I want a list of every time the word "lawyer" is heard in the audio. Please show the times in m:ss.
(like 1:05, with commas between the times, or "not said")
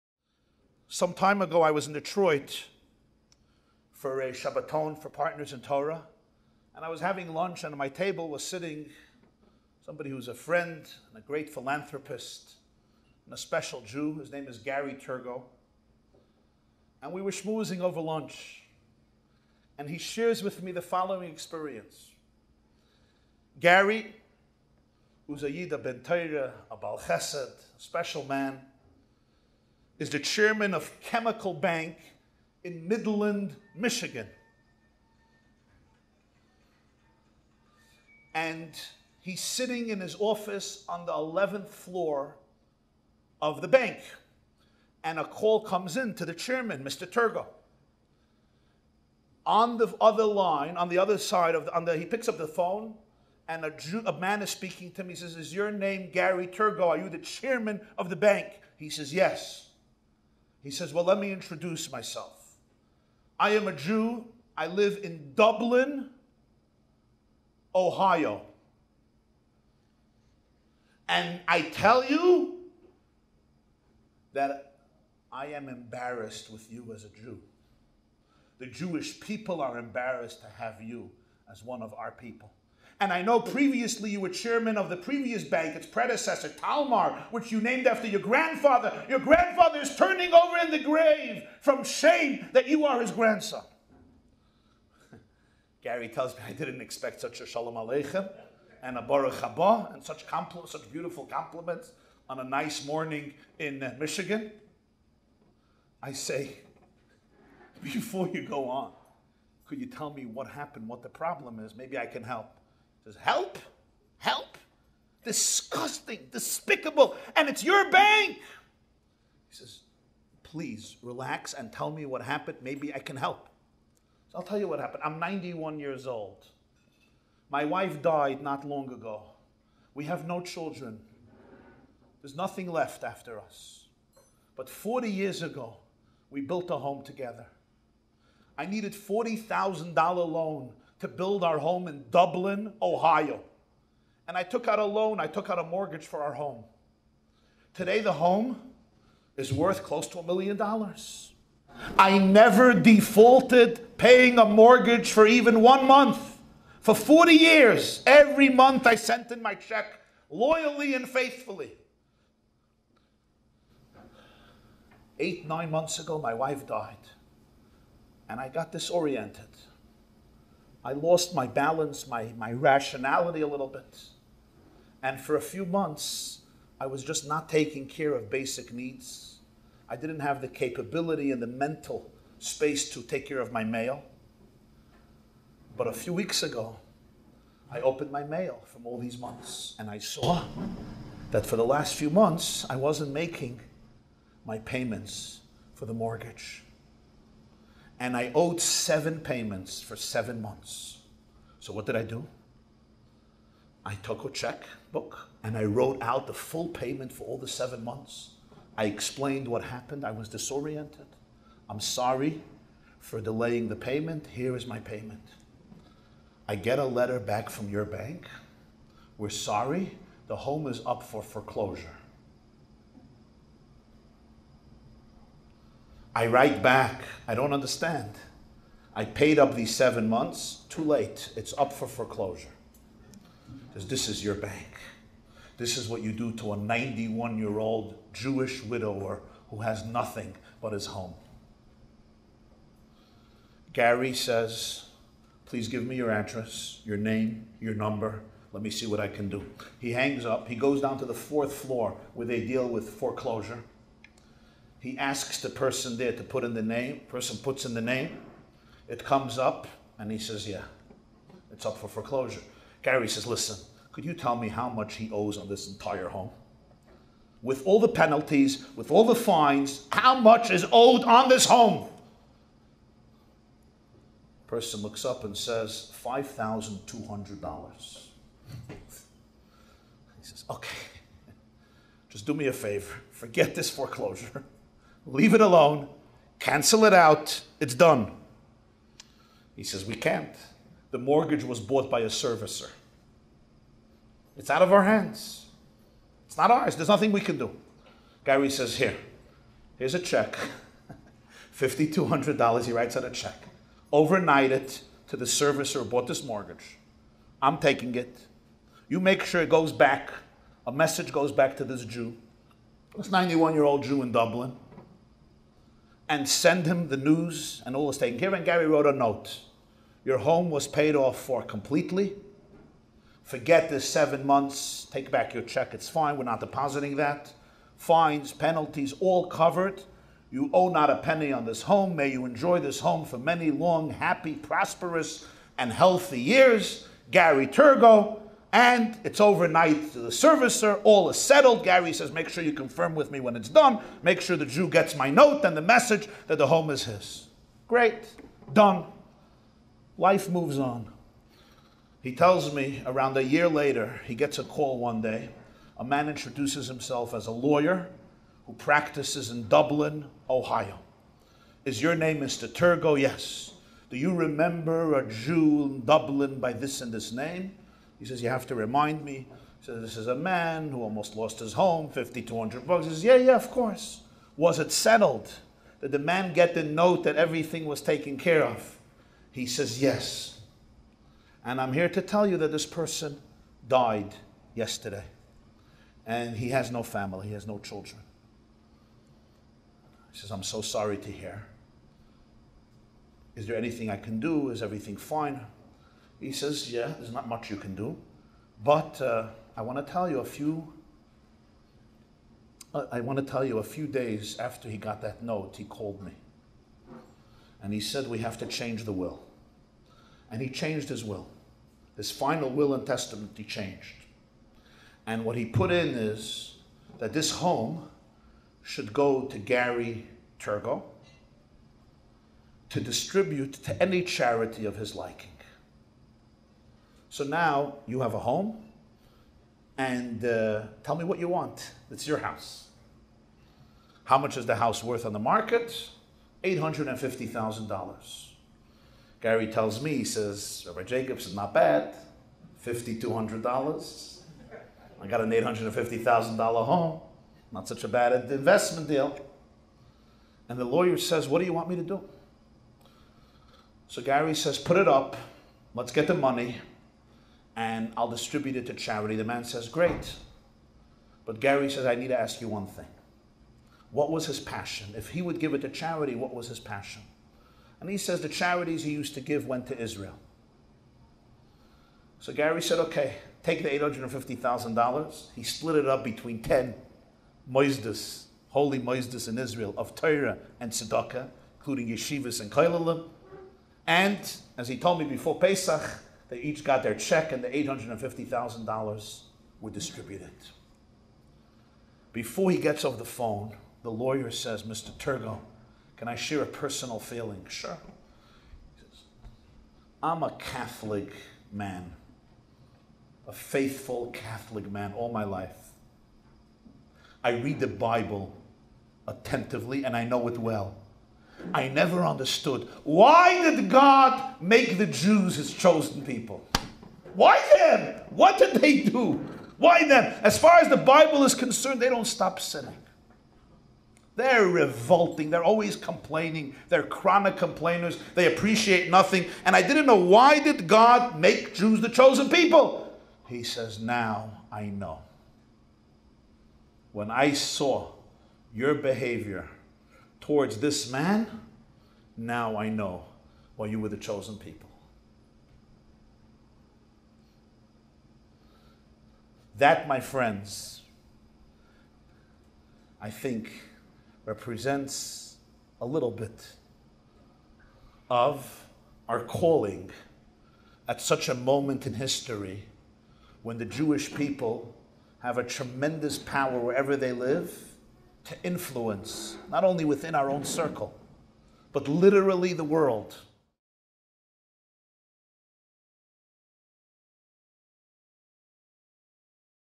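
5:57, 7:30, 8:13.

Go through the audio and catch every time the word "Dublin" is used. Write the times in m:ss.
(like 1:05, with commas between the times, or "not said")
1:05, 2:22, 5:14, 5:59, 6:05.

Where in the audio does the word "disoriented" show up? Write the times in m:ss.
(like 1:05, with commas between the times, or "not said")
2:48, 3:30.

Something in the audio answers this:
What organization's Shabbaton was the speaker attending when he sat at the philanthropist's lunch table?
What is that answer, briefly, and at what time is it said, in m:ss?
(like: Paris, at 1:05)
Partners in Torah, at 0:05.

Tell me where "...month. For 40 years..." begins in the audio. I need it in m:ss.
2:35.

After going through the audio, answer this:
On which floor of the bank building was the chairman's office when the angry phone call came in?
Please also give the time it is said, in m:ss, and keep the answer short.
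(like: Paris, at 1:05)
11th, at 0:41.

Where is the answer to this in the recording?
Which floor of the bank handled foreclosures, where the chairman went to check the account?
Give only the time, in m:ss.
4:11.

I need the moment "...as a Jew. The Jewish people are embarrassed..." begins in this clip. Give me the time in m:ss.
1:16.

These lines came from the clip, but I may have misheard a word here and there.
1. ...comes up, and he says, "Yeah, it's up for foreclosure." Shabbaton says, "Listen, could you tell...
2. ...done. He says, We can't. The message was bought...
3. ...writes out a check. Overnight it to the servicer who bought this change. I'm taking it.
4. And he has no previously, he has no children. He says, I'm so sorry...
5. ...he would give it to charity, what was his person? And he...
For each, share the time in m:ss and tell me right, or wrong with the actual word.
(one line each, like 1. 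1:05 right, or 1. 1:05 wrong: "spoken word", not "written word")
1. 4:19 wrong: "Gary", not "Shabbaton"
2. 4:47 wrong: "mortgage", not "message"
3. 5:02 wrong: "mortgage", not "change"
4. 6:26 wrong: "family", not "previously"
5. 7:45 wrong: "passion", not "person".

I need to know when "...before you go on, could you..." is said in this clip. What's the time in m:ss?
1:47.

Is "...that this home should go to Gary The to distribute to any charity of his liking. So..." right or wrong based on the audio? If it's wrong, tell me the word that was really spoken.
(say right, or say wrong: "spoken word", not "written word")
wrong: "Torgow", not "The".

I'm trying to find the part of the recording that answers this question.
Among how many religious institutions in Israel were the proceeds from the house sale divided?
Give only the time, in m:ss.
7:56.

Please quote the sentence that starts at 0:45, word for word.
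And a call comes in to the chairman, Mr.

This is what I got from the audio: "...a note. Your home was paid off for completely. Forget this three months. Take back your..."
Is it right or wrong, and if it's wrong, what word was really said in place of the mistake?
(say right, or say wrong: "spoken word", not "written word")
wrong: "seven", not "three".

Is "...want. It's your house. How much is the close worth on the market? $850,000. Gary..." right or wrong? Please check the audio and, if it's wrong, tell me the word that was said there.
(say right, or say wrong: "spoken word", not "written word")
wrong: "house", not "close".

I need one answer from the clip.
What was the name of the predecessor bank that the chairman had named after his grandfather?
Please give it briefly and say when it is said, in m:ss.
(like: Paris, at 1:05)
Talmer, at 1:26.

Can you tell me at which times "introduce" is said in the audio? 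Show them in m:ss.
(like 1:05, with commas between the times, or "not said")
1:01, 5:56.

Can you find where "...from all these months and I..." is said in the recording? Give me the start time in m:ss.
3:08.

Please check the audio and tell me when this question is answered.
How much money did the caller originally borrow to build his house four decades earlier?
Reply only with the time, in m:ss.
2:18.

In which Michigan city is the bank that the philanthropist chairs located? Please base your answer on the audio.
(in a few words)
Midland.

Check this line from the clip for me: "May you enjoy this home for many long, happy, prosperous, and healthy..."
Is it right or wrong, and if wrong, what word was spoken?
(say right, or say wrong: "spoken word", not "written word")
right.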